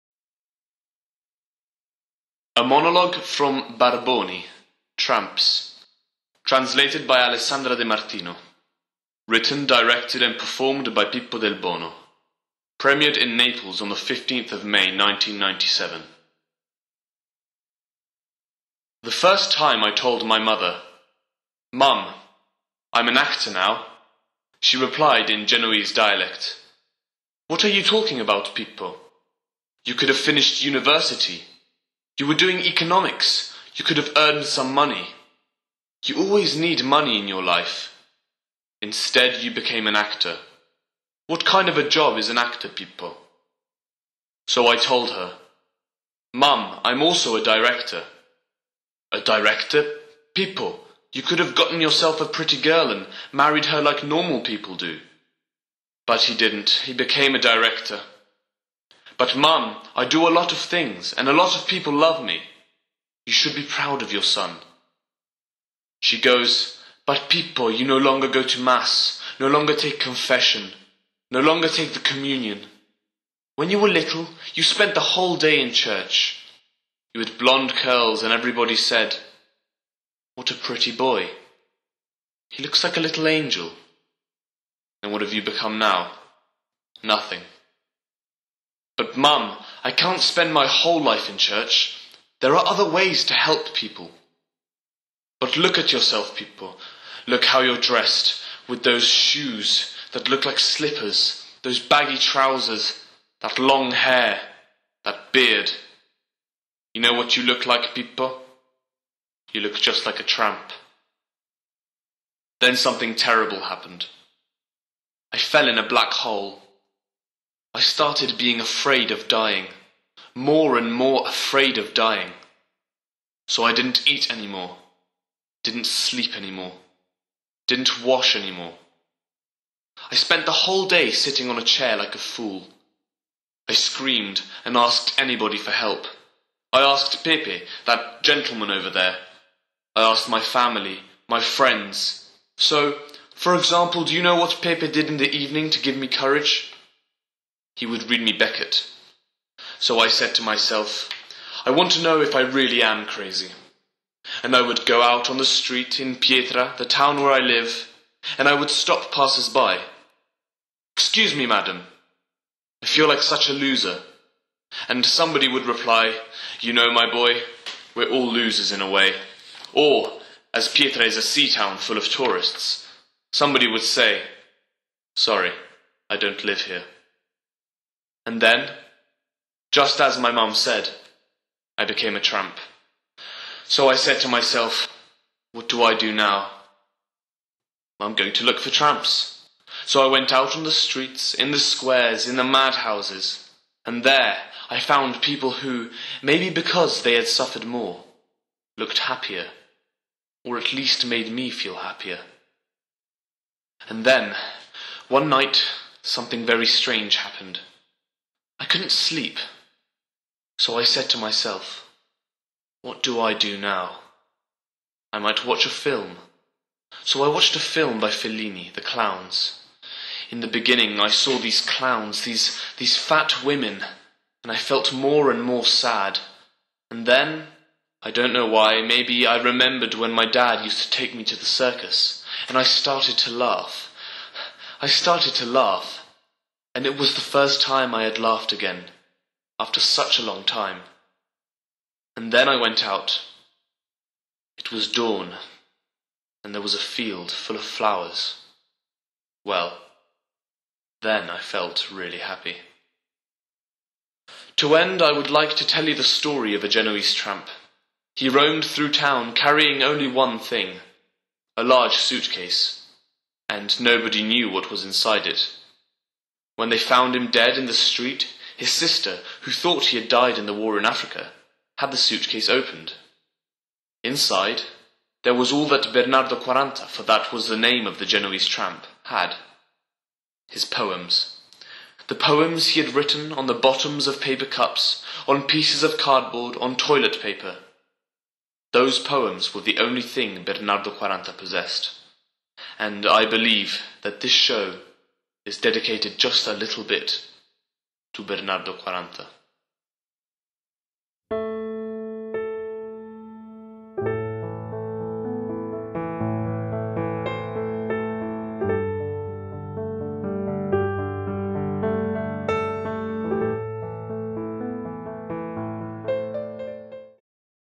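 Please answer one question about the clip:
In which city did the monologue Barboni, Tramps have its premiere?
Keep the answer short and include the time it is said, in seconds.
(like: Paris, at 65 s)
Naples, at 13 s.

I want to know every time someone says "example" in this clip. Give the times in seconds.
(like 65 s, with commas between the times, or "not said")
143 s.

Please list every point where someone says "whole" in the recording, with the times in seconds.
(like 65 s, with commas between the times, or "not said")
75 s, 90 s, 130 s.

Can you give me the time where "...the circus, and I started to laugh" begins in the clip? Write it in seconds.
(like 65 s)
231 s.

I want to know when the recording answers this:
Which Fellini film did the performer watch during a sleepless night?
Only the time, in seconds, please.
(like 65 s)
218 s.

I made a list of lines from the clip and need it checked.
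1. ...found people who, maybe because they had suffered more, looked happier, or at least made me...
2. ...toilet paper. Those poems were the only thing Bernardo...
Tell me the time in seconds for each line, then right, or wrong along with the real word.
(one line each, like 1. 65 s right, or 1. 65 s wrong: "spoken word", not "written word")
1. 194 s right
2. 286 s right.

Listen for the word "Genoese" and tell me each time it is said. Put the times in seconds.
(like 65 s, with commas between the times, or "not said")
25 s, 256 s, 278 s.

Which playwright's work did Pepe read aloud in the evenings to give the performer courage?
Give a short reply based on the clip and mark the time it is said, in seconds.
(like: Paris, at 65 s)
Beckett, at 148 s.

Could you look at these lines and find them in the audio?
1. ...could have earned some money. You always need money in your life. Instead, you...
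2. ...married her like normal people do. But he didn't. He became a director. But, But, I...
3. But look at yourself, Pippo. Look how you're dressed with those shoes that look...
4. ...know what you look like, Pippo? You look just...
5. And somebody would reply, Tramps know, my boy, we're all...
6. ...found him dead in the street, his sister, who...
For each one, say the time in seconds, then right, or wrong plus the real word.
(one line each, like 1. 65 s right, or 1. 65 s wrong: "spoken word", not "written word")
1. 33 s right
2. 53 s wrong: "Mum", not "But"
3. 95 s right
4. 107 s right
5. 164 s wrong: "You", not "Tramps"
6. 266 s right.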